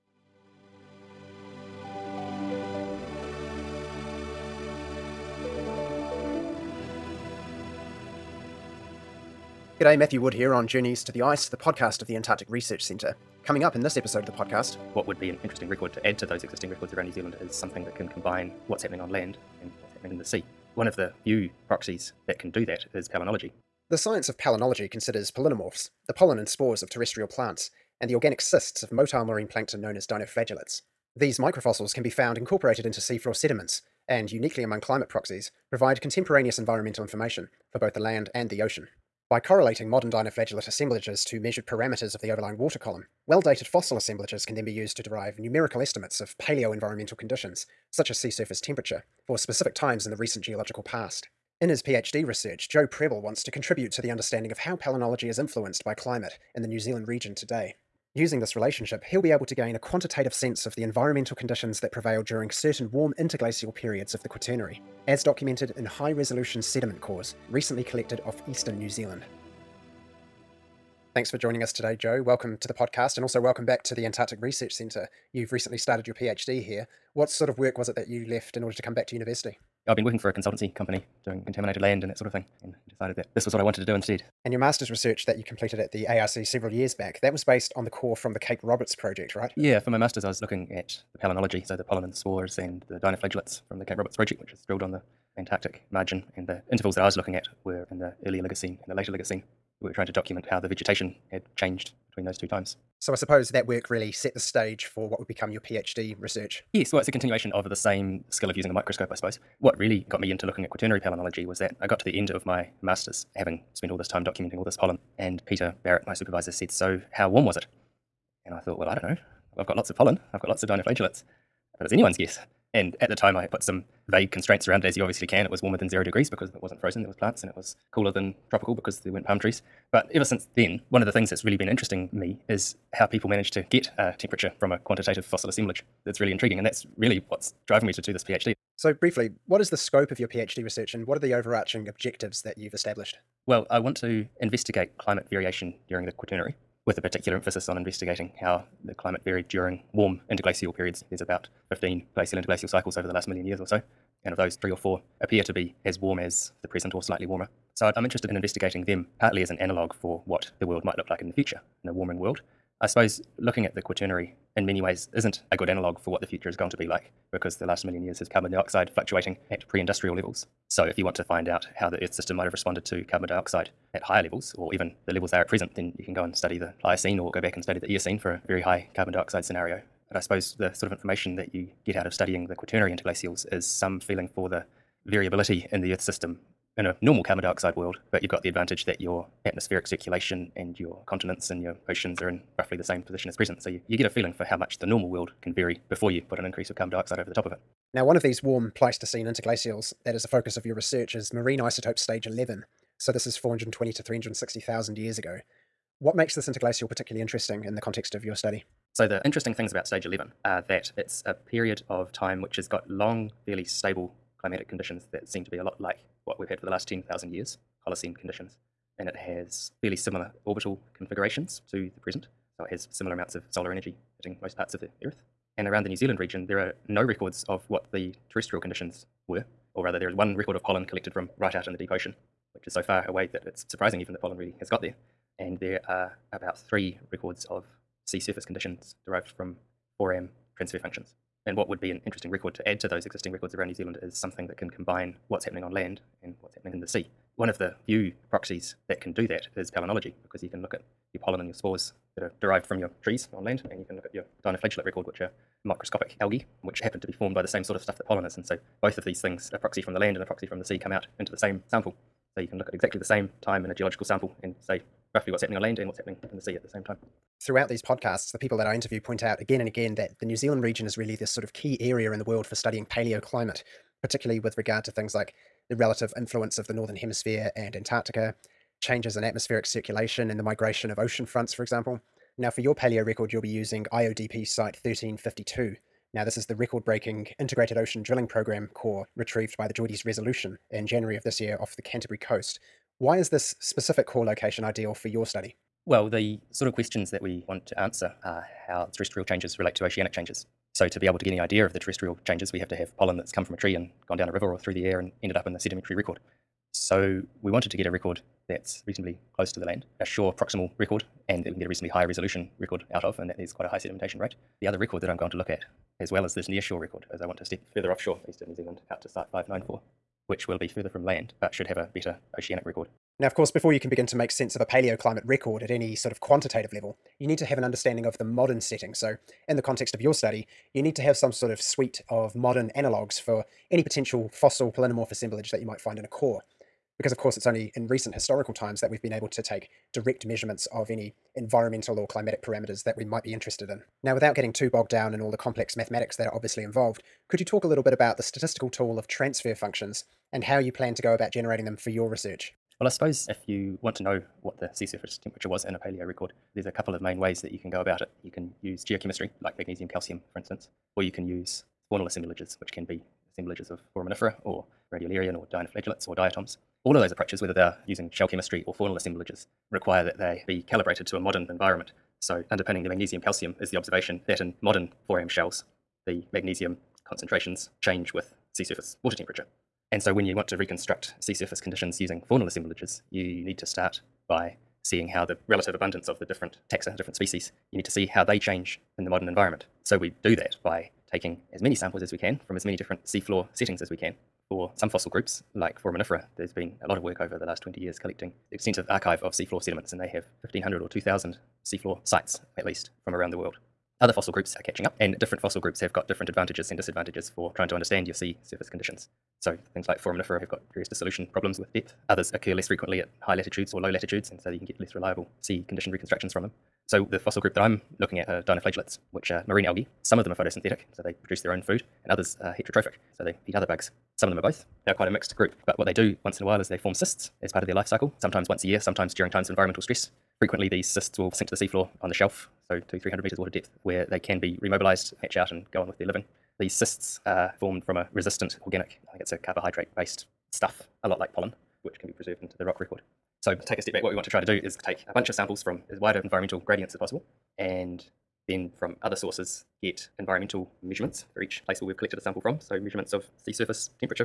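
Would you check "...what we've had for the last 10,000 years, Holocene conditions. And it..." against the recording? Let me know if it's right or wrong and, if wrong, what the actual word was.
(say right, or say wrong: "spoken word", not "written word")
right.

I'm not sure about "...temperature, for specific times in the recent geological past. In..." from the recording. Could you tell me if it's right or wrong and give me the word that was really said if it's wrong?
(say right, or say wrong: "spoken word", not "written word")
right.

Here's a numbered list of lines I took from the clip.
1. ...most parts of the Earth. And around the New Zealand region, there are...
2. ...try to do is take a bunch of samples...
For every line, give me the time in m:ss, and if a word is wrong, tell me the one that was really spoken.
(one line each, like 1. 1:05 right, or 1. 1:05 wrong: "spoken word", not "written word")
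1. 3:44 right
2. 7:24 right.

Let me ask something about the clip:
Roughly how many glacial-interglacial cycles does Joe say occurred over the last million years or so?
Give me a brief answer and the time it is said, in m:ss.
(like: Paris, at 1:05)
15, at 2:31.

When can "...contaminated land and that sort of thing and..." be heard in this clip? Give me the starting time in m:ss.
1:21.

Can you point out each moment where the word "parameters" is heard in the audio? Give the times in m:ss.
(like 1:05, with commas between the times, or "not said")
0:41, 5:42.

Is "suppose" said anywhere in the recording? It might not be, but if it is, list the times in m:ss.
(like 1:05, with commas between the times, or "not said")
1:43, 1:49, 2:42, 3:00, 5:52.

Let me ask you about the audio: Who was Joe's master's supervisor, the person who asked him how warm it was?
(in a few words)
Peter Barrett.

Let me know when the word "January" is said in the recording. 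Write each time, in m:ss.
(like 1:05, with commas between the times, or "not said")
4:50.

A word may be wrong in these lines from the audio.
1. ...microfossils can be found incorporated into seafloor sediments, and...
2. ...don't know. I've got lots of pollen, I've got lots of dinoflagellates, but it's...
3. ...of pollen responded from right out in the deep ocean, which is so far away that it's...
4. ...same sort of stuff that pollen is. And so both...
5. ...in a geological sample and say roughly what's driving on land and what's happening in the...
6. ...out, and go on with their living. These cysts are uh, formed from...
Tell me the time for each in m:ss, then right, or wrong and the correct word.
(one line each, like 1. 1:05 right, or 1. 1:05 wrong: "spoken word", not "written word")
1. 0:31 right
2. 1:58 right
3. 3:50 wrong: "collected", not "responded"
4. 4:17 right
5. 4:23 wrong: "happening", not "driving"
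6. 7:15 right.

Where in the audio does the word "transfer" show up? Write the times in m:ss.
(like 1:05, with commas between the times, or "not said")
4:00, 5:49.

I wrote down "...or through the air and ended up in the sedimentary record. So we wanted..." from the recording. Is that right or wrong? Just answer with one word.
right.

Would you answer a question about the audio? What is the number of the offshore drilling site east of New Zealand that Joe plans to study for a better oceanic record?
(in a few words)
594.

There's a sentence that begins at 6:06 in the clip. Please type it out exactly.
All of those approaches, whether they're using shell chemistry or faunal assemblages, require that they be calibrated to a modern environment.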